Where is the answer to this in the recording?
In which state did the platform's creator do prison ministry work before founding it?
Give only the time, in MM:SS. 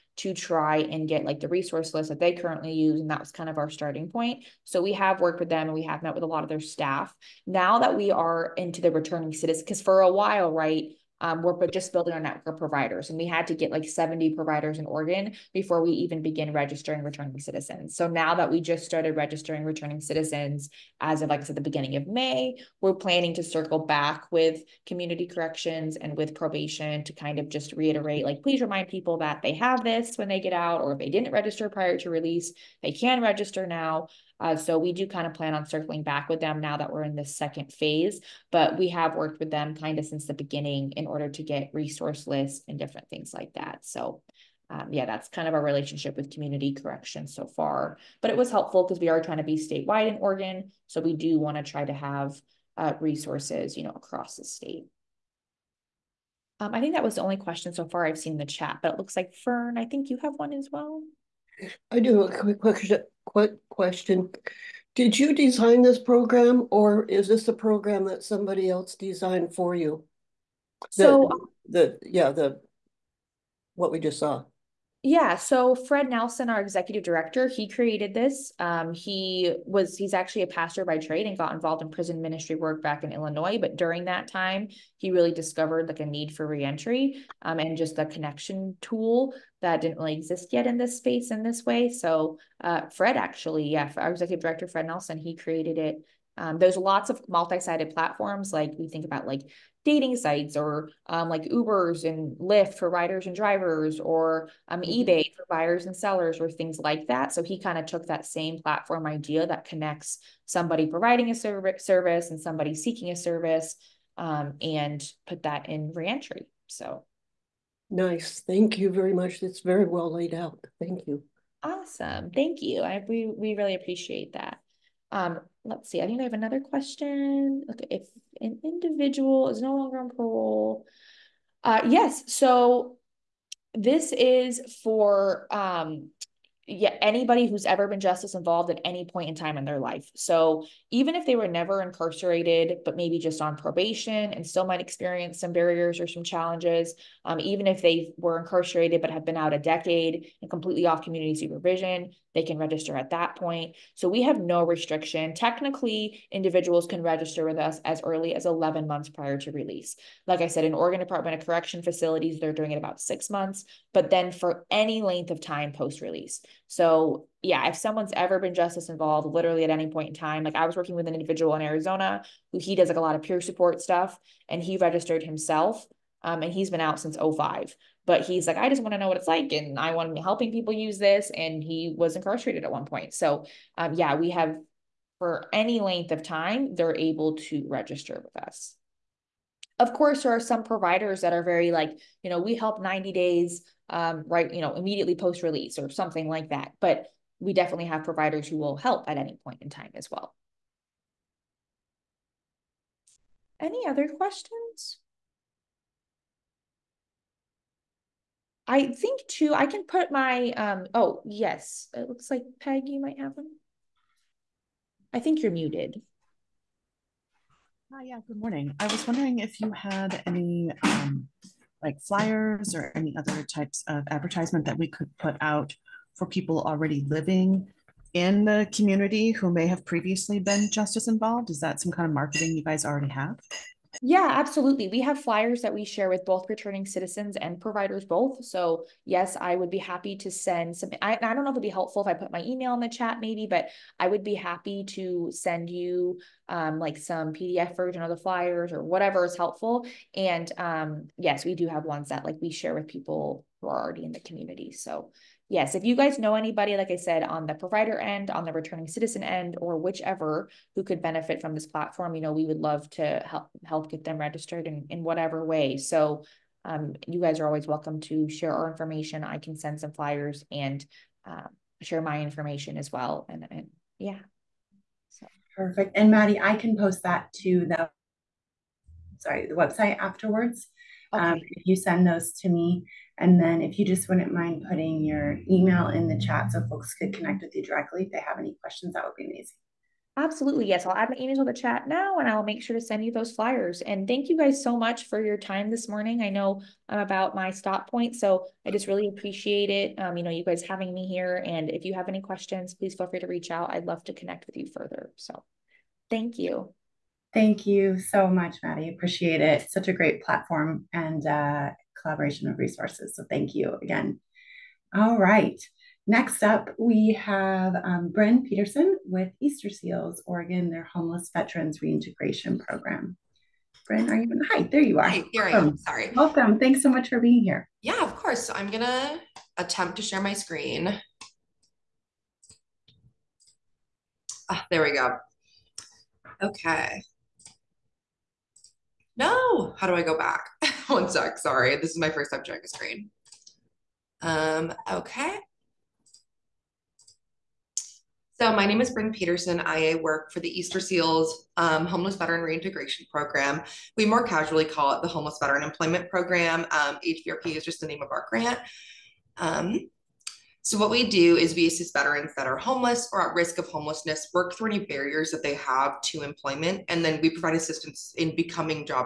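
01:23.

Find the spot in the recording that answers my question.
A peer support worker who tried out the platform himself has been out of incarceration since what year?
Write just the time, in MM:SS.
02:57.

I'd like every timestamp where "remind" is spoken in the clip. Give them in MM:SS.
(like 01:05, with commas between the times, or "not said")
00:28.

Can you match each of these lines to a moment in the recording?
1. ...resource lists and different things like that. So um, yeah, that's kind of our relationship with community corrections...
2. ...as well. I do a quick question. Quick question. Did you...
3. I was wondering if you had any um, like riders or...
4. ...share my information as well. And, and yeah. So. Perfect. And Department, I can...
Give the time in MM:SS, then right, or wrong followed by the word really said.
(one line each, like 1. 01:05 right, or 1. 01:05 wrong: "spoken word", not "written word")
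1. 00:41 right
2. 01:00 right
3. 03:38 wrong: "flyers", not "riders"
4. 04:31 wrong: "Maddie", not "Department".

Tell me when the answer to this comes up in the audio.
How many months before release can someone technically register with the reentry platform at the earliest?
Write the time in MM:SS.
02:38.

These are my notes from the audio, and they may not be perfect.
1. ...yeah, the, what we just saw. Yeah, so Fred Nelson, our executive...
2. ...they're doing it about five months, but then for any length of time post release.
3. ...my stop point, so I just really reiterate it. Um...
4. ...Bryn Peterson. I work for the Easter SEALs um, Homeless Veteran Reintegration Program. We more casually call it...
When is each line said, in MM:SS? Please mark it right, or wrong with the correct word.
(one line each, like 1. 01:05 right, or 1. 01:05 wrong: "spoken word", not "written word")
1. 01:12 right
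2. 02:42 wrong: "six", not "five"
3. 04:57 wrong: "appreciate", not "reiterate"
4. 05:48 right.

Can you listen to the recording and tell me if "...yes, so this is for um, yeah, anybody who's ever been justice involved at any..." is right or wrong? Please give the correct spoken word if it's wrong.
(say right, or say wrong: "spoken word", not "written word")
right.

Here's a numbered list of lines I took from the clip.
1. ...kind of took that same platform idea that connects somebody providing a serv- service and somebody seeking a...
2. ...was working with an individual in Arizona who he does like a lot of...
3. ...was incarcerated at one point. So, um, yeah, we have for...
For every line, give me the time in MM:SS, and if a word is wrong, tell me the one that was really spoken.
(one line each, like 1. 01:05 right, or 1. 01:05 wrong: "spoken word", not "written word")
1. 01:47 right
2. 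02:50 right
3. 03:01 right.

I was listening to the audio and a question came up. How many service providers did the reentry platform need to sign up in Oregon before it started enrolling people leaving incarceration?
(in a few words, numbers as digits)
70.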